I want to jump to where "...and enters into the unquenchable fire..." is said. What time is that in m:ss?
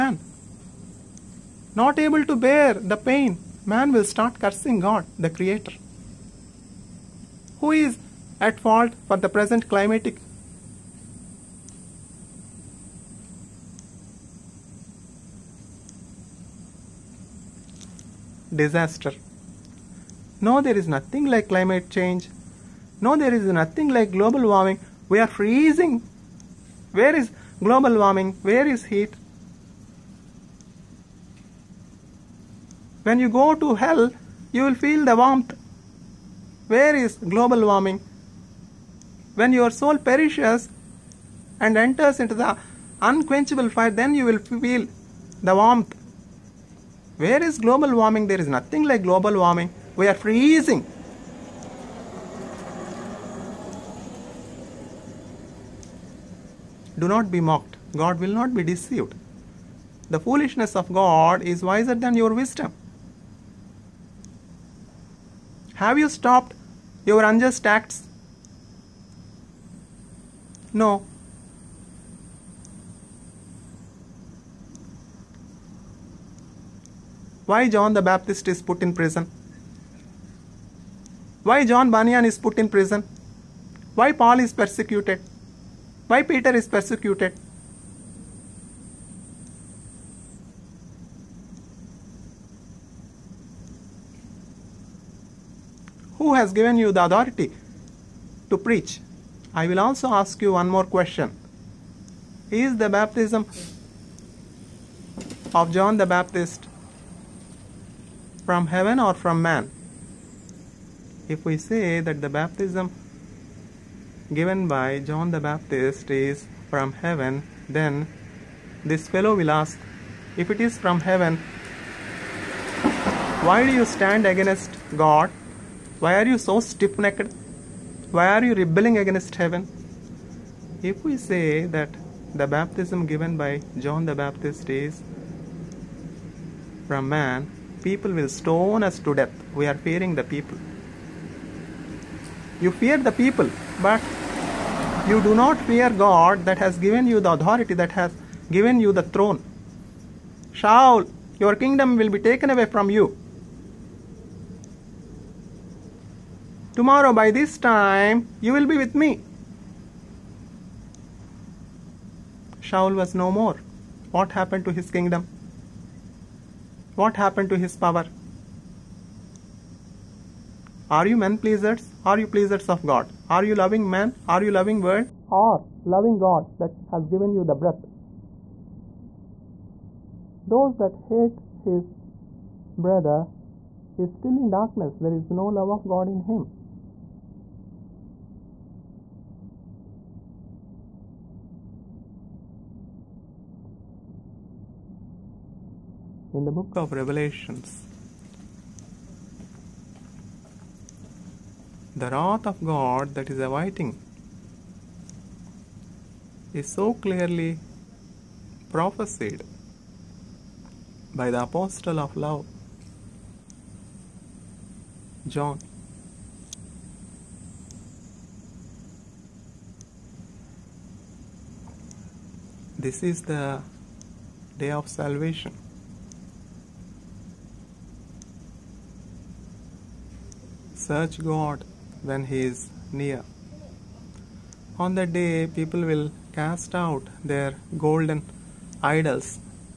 0:41.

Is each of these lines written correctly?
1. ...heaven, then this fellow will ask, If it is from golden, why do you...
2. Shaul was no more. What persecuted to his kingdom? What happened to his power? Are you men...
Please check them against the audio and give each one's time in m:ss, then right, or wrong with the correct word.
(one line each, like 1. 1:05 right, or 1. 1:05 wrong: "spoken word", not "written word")
1. 1:56 wrong: "heaven", not "golden"
2. 2:42 wrong: "happened", not "persecuted".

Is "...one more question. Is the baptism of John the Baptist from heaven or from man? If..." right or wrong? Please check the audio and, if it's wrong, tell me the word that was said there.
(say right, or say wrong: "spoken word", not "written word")
right.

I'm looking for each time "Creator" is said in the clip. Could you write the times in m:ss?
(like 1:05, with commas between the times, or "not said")
0:05.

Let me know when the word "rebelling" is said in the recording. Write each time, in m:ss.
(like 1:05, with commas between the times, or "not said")
2:08.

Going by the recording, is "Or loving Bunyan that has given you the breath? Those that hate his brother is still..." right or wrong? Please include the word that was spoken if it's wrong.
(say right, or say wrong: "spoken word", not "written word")
wrong: "God", not "Bunyan".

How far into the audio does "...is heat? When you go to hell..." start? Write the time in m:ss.
0:28.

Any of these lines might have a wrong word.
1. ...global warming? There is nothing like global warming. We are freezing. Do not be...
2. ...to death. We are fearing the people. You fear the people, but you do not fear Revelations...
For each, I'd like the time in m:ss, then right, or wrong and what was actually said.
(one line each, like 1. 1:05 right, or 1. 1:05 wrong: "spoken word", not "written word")
1. 0:47 right
2. 2:19 wrong: "God", not "Revelations".